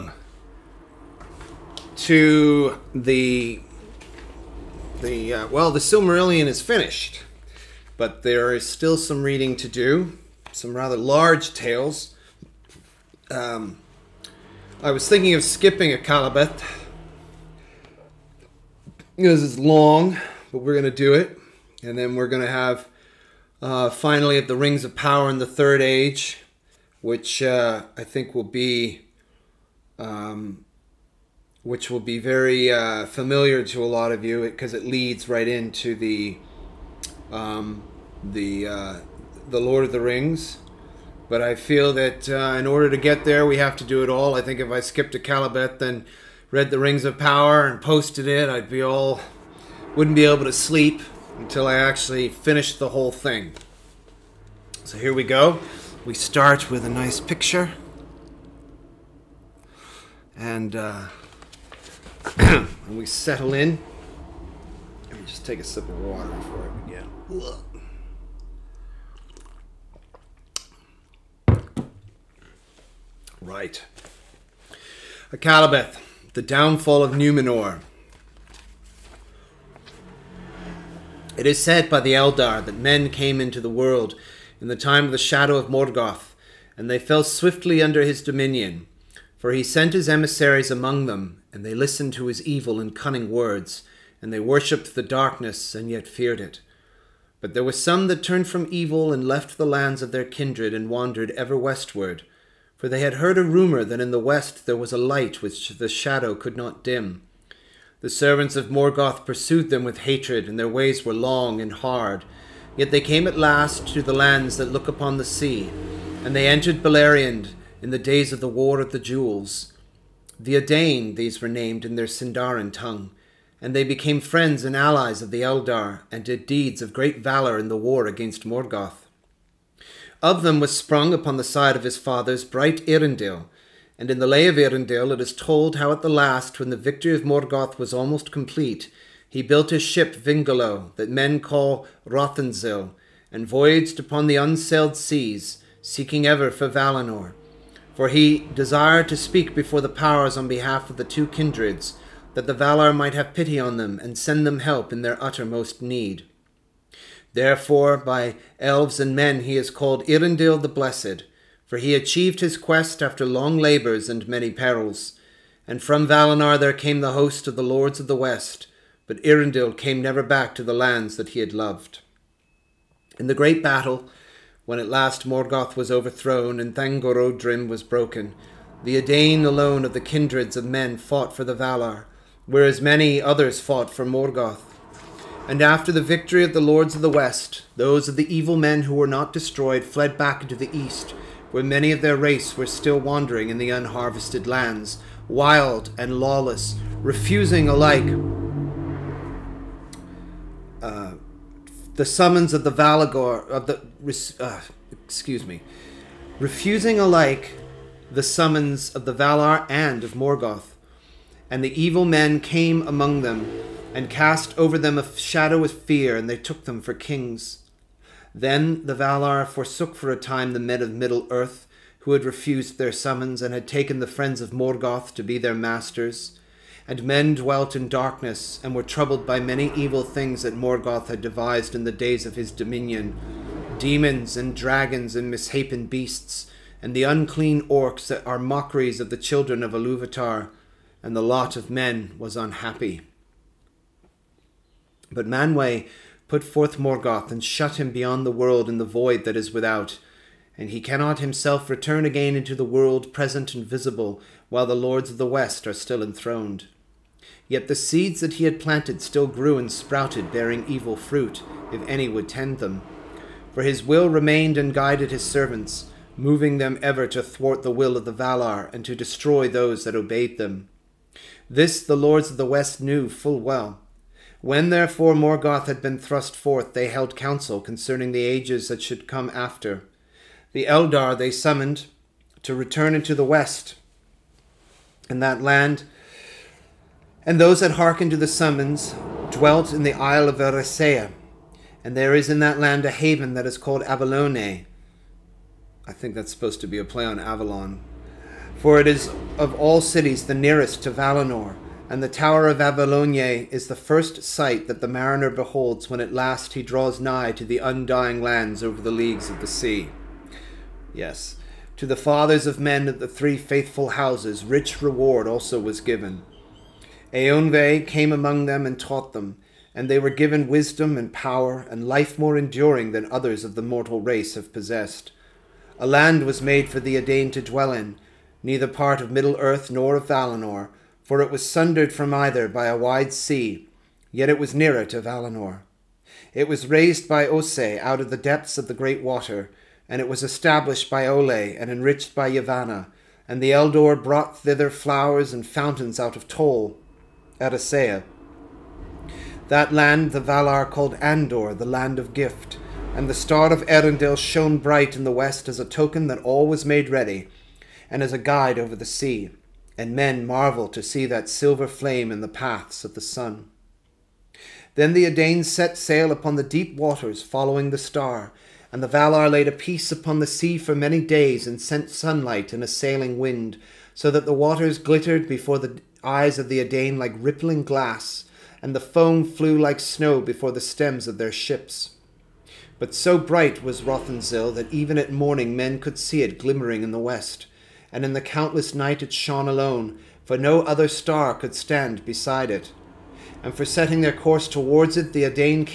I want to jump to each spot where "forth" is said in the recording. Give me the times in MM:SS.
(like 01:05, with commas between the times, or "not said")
04:06, 04:36.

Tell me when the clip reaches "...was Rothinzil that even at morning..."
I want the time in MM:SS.
06:23.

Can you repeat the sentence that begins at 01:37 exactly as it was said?
But there were some that turned from evil and left the lands of their kindred and wandered ever westward.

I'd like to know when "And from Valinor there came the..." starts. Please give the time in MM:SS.
02:45.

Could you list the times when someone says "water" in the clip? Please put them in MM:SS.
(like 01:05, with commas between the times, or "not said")
01:06, 05:39, 06:06, 06:14.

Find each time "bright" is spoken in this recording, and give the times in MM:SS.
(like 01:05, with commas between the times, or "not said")
02:12, 05:54, 06:23.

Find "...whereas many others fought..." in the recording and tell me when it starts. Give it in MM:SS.
03:02.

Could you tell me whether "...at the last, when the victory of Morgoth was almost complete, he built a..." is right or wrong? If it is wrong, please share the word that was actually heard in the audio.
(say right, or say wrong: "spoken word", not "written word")
right.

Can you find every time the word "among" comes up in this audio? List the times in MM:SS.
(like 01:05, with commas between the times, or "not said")
01:30, 03:32, 05:18.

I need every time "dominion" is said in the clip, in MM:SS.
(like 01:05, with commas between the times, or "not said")
01:28, 03:52.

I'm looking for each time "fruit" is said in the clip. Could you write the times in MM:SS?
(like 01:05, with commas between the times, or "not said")
04:20.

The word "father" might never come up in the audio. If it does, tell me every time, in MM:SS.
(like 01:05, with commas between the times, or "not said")
02:11, 05:11.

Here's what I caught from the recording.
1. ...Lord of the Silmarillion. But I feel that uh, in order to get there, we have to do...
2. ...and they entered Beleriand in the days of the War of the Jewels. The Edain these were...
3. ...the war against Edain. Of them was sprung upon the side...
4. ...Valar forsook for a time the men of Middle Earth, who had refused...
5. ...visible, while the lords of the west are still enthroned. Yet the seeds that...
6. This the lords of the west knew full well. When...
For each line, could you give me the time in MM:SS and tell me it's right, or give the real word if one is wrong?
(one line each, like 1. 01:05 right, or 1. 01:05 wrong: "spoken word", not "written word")
1. 00:39 wrong: "Rings", not "Silmarillion"
2. 01:56 right
3. 02:07 wrong: "Morgoth", not "Edain"
4. 03:38 right
5. 04:13 right
6. 04:31 right.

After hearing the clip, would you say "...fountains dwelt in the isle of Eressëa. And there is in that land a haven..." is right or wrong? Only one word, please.
wrong.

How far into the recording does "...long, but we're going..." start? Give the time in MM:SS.
00:19.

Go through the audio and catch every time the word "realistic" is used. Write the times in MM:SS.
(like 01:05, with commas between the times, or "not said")
not said.